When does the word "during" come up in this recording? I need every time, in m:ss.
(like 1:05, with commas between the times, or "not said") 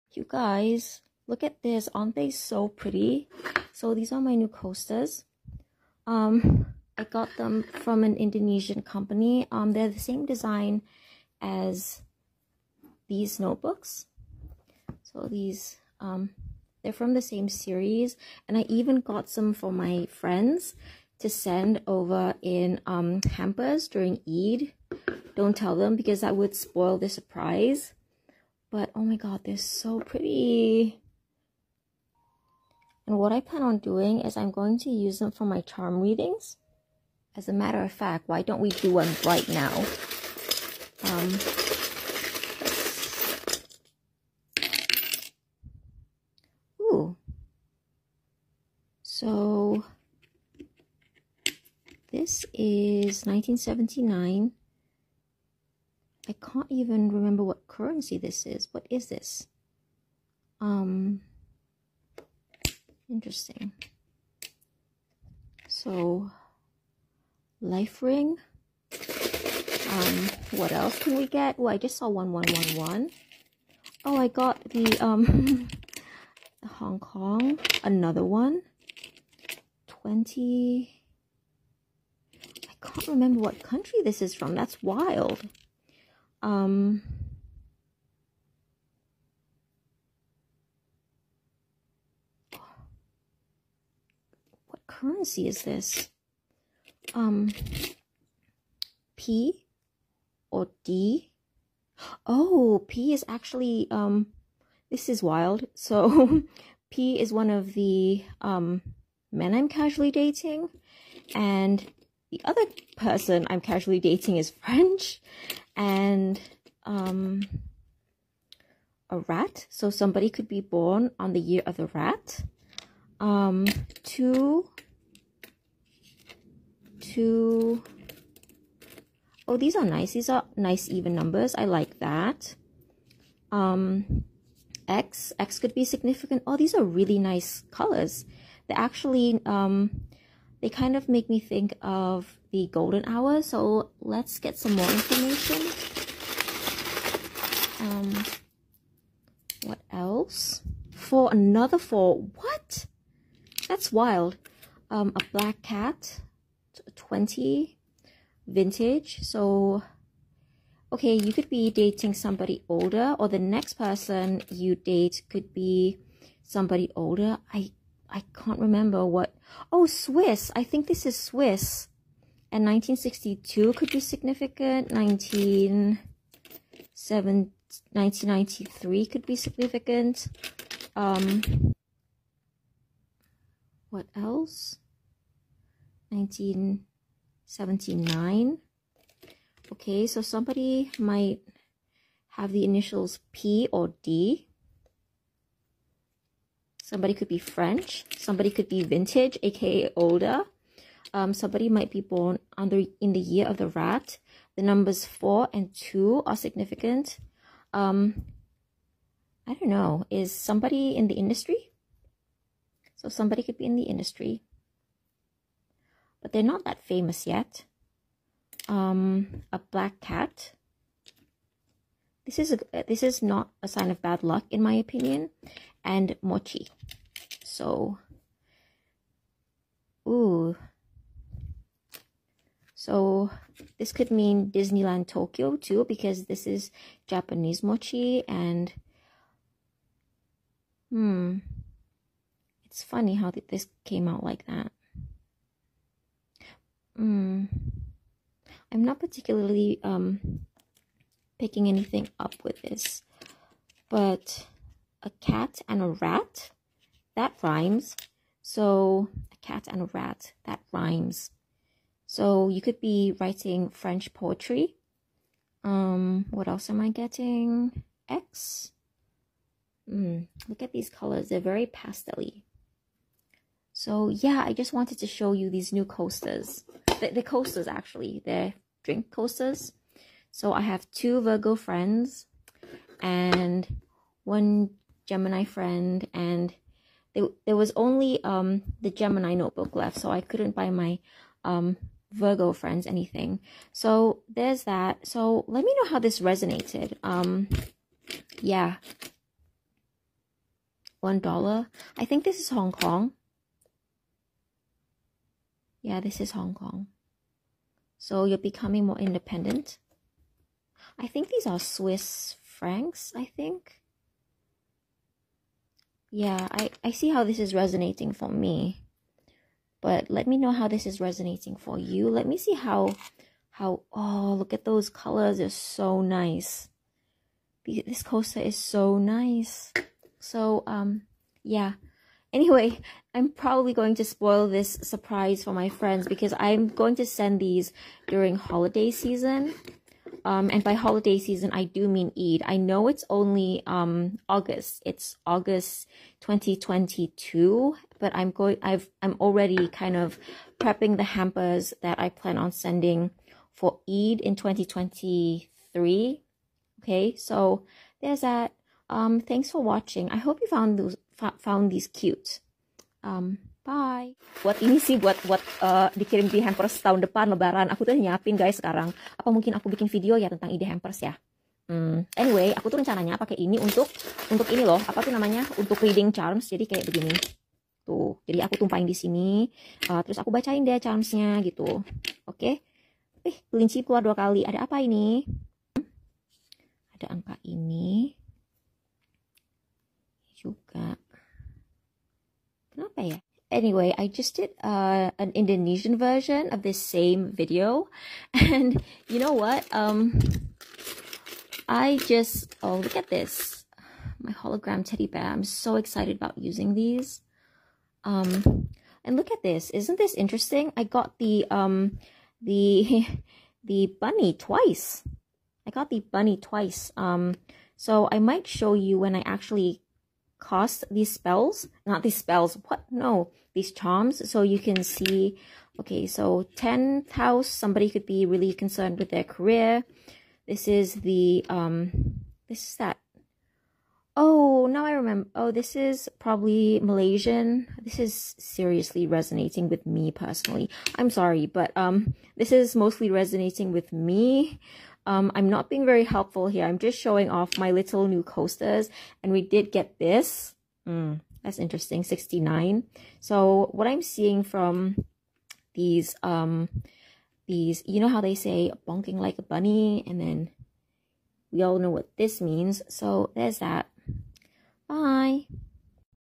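0:23, 5:38.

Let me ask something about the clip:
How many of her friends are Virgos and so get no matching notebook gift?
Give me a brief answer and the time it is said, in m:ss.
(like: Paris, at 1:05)
2, at 4:40.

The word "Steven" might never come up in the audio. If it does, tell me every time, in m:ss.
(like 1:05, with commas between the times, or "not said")
not said.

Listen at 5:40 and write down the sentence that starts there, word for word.
Um, and by holiday season, I do mean Eid.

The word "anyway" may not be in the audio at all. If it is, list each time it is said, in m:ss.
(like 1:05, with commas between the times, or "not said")
5:32, 6:12, 6:33.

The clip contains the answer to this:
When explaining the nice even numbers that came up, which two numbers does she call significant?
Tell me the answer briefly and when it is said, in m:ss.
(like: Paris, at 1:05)
4 and 2, at 3:25.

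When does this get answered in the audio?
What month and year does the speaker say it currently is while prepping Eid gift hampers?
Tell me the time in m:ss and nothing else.
5:45.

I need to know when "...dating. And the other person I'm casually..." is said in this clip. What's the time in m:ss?
1:50.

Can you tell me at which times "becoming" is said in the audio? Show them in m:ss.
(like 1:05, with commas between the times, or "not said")
5:08.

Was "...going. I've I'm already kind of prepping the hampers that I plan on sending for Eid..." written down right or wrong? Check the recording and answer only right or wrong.
right.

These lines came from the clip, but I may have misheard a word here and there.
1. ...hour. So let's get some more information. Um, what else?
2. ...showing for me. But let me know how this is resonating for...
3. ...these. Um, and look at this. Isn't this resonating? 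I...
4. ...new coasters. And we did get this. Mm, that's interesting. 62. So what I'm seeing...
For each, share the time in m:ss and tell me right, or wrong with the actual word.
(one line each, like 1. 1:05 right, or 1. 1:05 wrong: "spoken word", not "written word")
1. 2:23 right
2. 5:17 wrong: "resonating", not "showing"
3. 6:46 wrong: "interesting", not "resonating"
4. 7:28 wrong: "69", not "62".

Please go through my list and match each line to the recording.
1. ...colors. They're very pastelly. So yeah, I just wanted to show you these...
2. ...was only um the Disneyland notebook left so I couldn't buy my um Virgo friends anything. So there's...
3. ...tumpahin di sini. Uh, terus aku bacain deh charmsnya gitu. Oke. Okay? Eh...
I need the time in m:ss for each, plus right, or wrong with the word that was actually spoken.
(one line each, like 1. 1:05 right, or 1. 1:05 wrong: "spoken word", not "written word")
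1. 4:30 right
2. 4:47 wrong: "Gemini", not "Disneyland"
3. 6:18 right.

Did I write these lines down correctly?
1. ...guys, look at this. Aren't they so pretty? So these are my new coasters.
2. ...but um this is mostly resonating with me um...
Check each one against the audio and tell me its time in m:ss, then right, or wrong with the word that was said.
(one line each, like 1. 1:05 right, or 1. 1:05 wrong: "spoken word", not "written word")
1. 0:00 right
2. 7:21 right.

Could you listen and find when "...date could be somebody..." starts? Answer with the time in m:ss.
2:44.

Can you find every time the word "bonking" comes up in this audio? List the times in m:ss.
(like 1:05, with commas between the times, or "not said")
7:38.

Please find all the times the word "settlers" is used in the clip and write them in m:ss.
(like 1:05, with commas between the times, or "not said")
not said.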